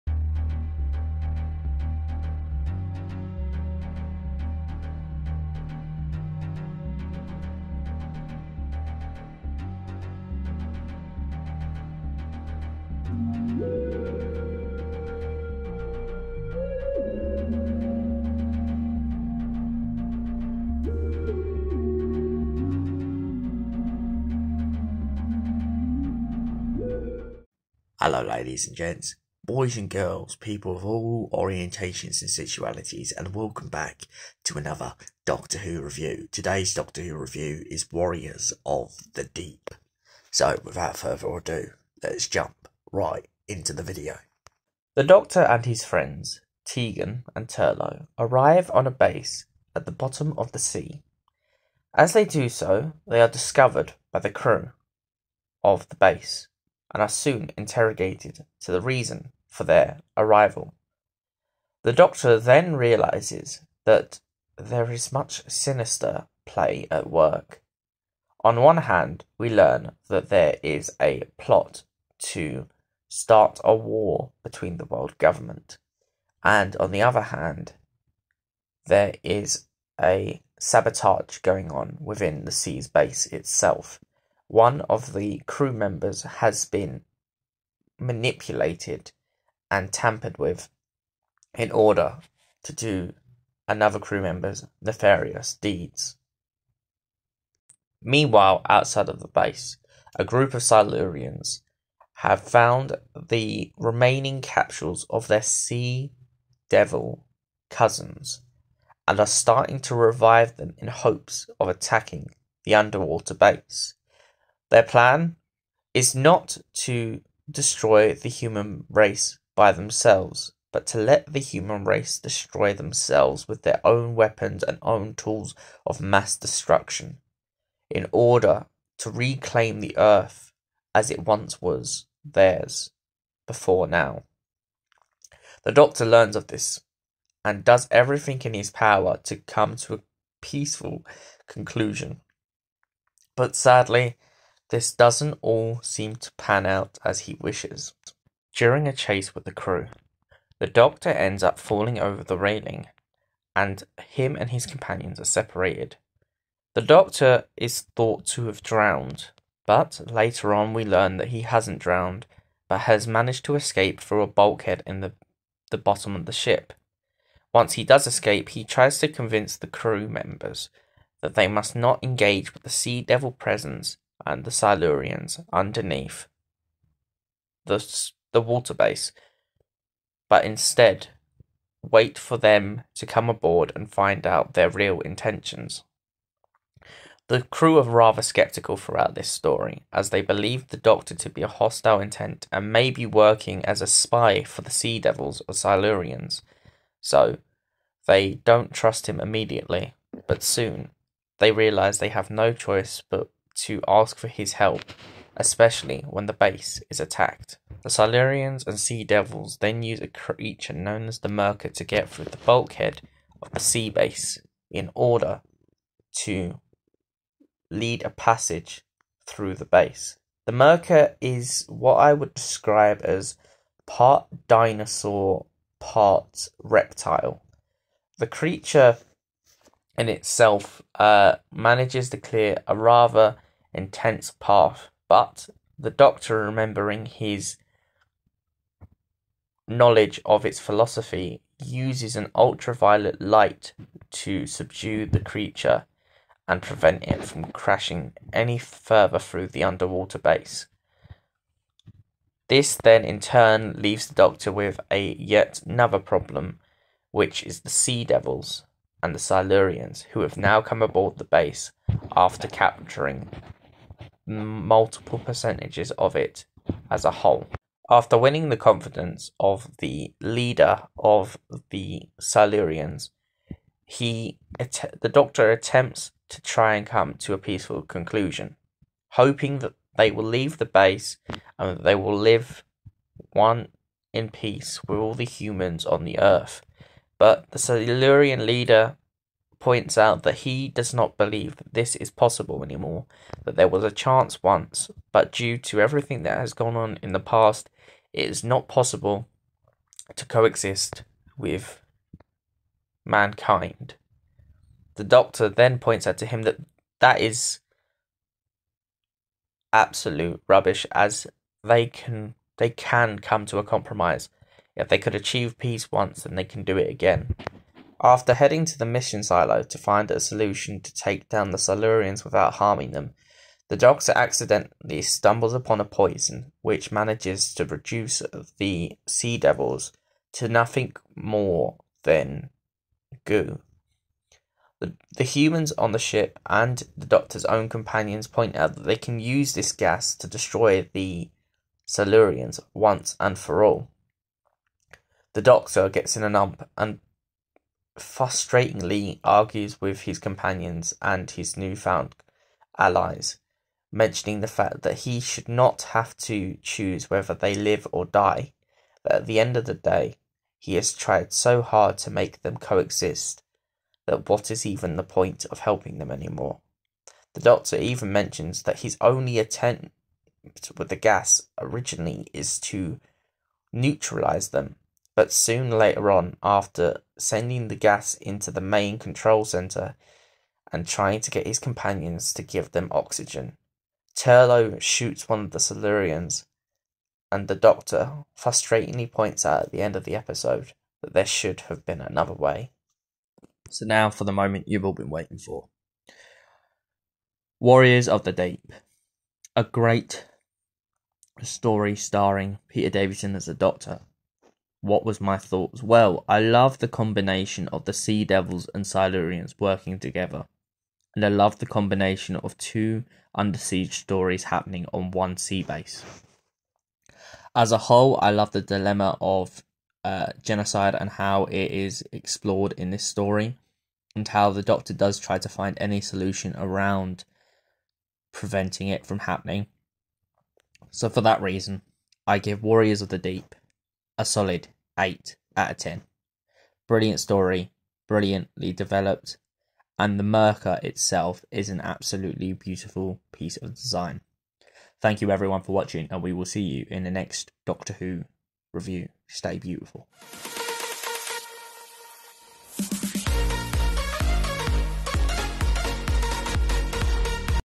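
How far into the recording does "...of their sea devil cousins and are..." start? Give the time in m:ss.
1:45.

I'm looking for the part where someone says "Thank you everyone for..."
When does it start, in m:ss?
7:25.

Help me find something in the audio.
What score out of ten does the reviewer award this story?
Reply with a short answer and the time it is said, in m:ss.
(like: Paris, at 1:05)
8, at 7:14.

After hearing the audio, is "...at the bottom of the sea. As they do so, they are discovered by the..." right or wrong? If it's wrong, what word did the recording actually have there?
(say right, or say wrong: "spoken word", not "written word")
right.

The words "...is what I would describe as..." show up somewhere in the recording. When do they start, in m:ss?
3:41.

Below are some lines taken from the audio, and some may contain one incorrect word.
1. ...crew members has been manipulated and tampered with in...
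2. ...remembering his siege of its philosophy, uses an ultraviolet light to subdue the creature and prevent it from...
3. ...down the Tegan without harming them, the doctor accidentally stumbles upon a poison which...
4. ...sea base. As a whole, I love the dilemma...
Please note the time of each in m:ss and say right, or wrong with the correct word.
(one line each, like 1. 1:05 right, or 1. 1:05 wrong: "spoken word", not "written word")
1. 1:25 right
2. 3:56 wrong: "knowledge", not "siege"
3. 5:21 wrong: "Silurians", not "Tegan"
4. 6:55 right.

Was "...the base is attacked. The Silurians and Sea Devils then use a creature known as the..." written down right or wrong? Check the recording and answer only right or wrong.
right.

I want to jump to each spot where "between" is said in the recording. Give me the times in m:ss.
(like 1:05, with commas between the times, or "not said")
1:14.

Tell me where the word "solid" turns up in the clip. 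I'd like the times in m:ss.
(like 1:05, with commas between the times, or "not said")
7:14.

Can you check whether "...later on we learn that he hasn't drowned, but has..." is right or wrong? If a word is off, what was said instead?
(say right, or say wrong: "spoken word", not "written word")
right.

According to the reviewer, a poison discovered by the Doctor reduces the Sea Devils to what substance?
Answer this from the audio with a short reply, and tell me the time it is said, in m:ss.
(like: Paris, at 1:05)
Goo, at 5:33.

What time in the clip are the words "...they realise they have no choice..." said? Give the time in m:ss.
3:21.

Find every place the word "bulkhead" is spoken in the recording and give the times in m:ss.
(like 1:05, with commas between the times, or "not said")
2:44, 3:32.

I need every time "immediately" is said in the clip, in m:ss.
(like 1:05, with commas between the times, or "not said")
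3:19.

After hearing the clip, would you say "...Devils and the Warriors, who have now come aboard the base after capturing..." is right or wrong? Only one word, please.
wrong.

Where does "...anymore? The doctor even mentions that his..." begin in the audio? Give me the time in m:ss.
6:06.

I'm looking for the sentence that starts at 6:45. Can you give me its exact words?
Well, I love the combination of the Sea Devils and Silurians working together.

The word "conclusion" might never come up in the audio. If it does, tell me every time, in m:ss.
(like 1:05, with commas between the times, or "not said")
2:21, 4:37.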